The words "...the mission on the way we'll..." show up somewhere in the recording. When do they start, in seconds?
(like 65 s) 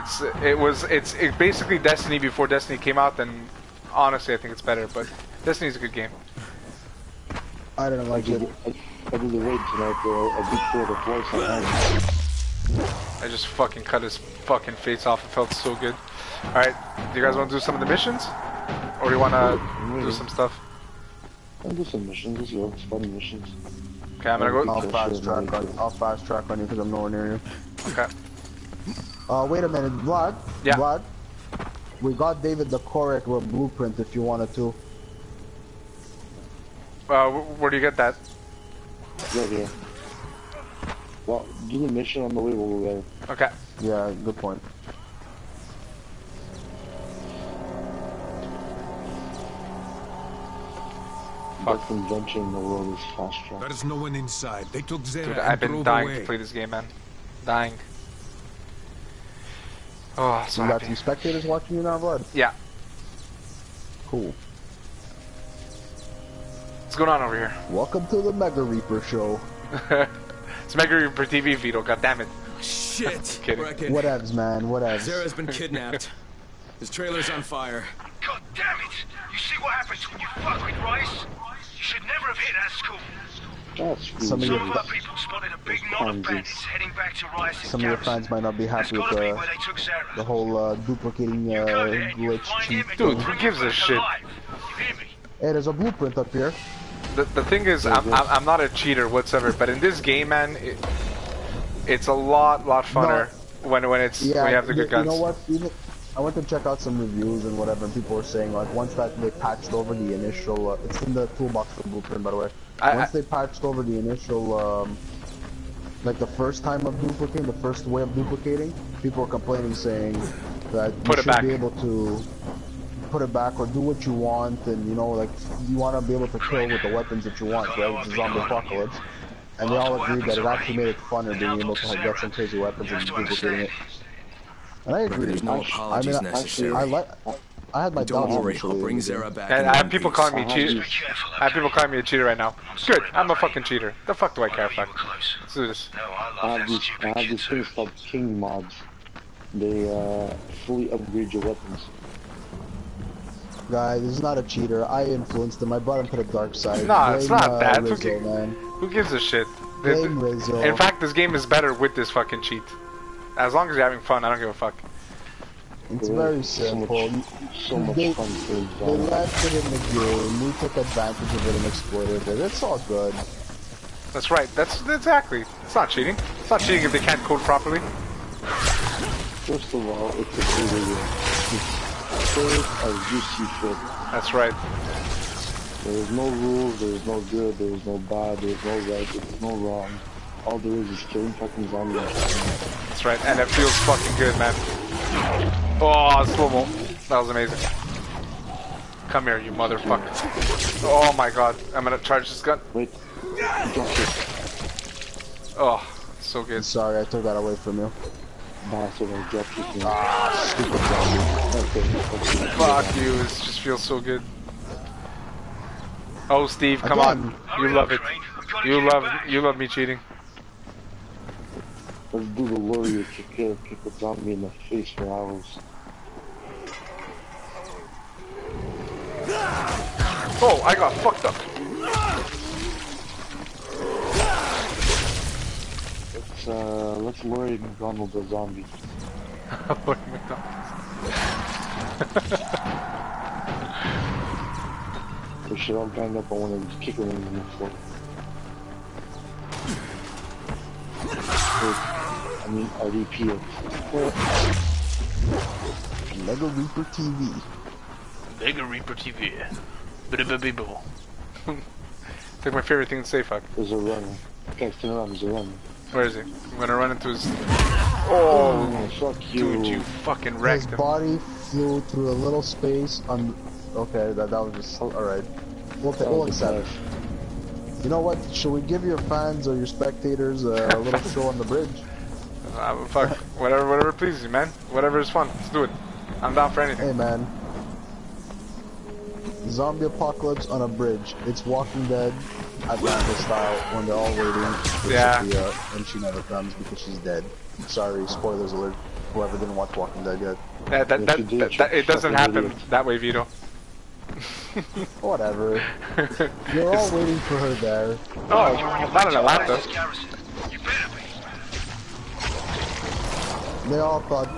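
41 s.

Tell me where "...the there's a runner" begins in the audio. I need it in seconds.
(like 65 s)
264 s.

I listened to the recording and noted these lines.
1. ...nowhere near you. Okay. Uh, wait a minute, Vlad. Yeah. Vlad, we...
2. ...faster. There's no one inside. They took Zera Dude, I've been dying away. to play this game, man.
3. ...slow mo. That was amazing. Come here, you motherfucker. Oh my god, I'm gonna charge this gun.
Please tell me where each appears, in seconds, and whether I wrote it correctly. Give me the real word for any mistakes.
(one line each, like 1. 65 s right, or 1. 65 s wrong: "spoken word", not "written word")
1. 26 s right
2. 53 s right
3. 196 s right.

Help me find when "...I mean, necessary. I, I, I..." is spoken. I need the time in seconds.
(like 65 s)
136 s.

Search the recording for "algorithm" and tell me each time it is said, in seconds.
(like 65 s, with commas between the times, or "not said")
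not said.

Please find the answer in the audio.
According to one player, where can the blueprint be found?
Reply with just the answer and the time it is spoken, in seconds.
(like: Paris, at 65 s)
In the toolbox, at 110 s.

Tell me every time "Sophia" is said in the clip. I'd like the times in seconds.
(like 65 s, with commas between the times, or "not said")
295 s.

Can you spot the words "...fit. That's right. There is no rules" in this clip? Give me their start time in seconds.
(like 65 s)
183 s.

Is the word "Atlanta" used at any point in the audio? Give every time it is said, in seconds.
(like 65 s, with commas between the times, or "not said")
292 s, 309 s.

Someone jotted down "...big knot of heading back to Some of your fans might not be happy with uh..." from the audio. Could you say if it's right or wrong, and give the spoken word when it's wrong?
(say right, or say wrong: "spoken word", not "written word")
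right.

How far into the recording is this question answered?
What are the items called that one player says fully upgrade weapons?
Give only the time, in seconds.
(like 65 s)
147 s.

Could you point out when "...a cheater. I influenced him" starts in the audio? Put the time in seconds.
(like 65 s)
154 s.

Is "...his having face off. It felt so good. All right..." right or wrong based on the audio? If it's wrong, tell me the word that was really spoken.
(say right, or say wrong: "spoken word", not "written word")
wrong: "fucking", not "having".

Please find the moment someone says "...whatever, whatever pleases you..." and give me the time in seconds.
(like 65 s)
283 s.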